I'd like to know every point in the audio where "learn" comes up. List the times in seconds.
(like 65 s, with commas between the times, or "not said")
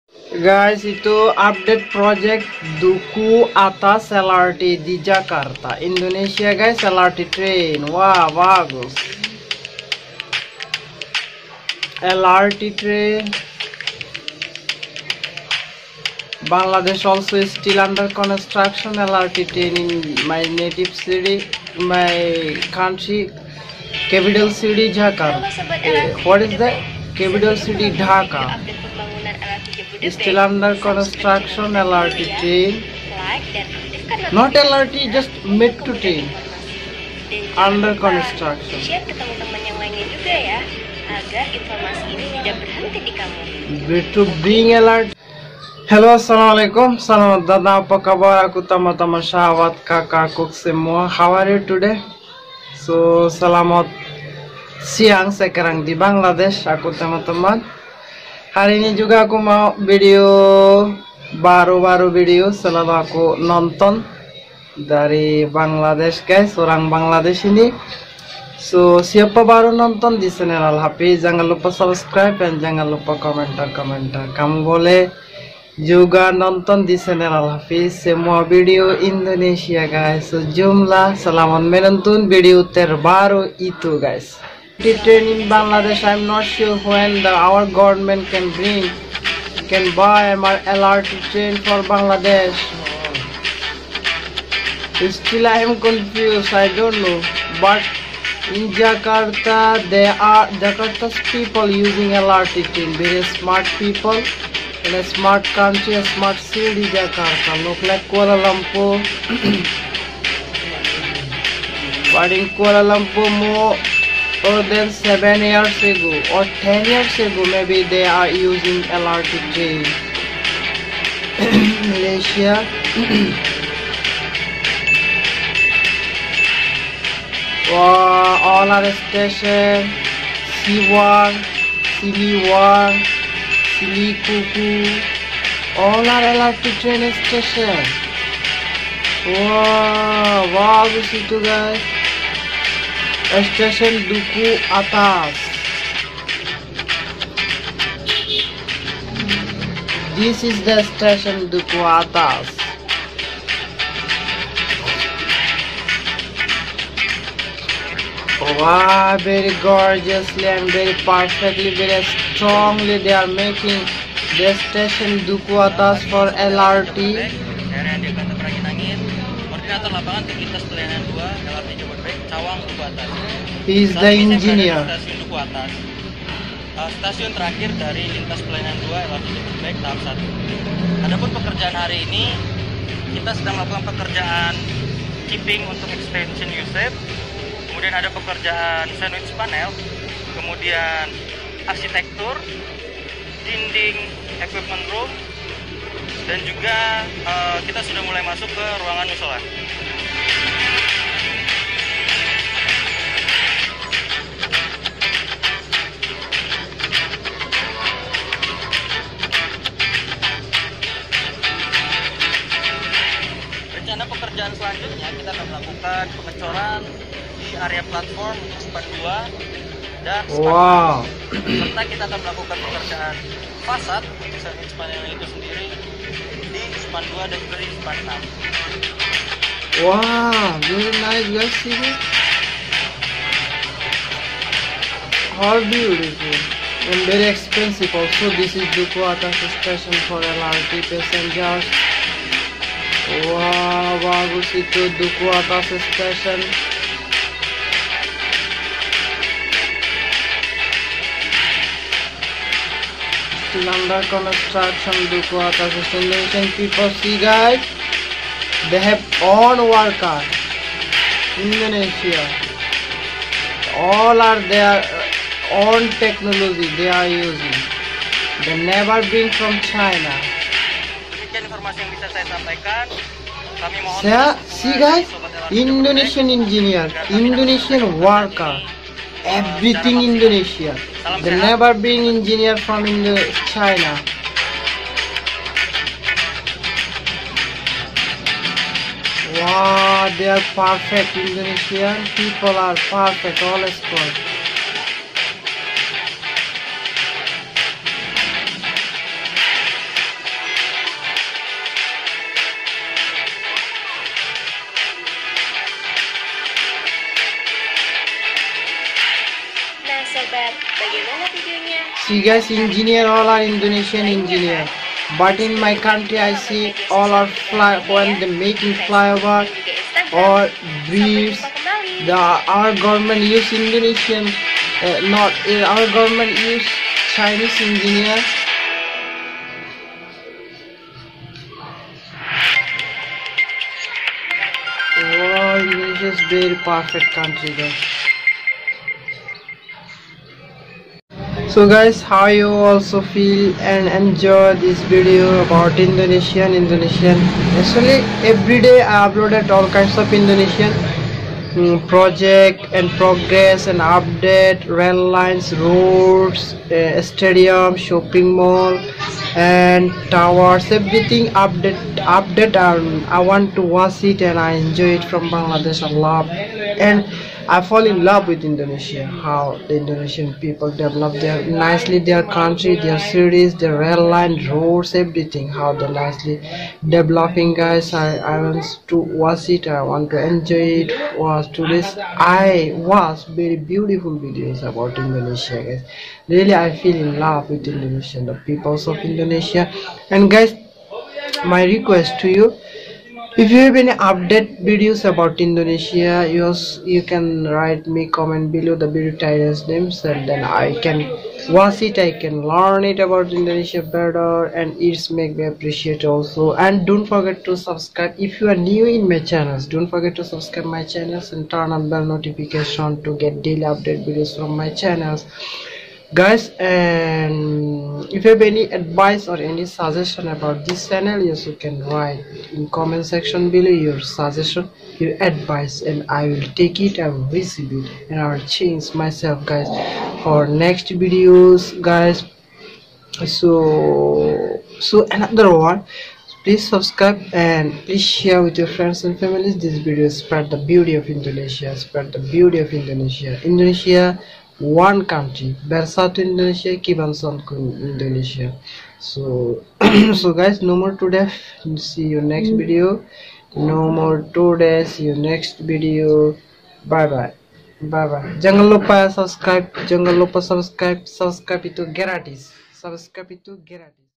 402 s.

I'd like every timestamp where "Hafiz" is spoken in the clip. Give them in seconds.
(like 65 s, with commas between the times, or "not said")
70 s, 77 s.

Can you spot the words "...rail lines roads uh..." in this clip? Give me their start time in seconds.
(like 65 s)
354 s.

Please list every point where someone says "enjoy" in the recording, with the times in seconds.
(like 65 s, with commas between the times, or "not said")
343 s, 364 s, 380 s.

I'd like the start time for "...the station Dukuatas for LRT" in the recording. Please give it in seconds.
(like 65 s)
164 s.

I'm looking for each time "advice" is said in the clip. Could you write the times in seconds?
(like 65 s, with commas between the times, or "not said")
418 s, 425 s.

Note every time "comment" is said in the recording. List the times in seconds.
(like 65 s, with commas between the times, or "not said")
398 s, 422 s.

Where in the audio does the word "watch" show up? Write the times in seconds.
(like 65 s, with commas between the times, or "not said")
363 s, 378 s, 401 s.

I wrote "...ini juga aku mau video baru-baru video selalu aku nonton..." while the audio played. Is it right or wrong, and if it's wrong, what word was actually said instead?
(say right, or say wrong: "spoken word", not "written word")
right.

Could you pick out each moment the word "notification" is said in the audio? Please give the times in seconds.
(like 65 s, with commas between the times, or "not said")
412 s.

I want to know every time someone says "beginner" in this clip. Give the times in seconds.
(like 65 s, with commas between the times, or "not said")
not said.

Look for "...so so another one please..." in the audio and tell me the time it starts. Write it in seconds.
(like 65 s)
433 s.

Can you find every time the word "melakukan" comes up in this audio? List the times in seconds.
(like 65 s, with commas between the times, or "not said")
183 s, 222 s.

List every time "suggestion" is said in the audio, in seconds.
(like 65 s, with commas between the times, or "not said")
419 s, 424 s.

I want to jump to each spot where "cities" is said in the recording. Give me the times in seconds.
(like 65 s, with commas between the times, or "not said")
372 s.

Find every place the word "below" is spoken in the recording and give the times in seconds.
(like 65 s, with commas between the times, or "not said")
398 s, 423 s.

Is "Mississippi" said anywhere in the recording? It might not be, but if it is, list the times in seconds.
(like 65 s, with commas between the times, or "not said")
not said.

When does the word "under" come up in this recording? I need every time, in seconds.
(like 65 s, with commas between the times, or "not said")
17 s, 30 s, 37 s, 253 s.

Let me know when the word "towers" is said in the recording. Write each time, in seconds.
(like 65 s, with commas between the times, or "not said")
360 s.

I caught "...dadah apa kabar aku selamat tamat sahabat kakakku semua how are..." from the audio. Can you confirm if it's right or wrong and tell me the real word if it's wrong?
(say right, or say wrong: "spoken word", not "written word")
wrong: "tamat", not "selamat".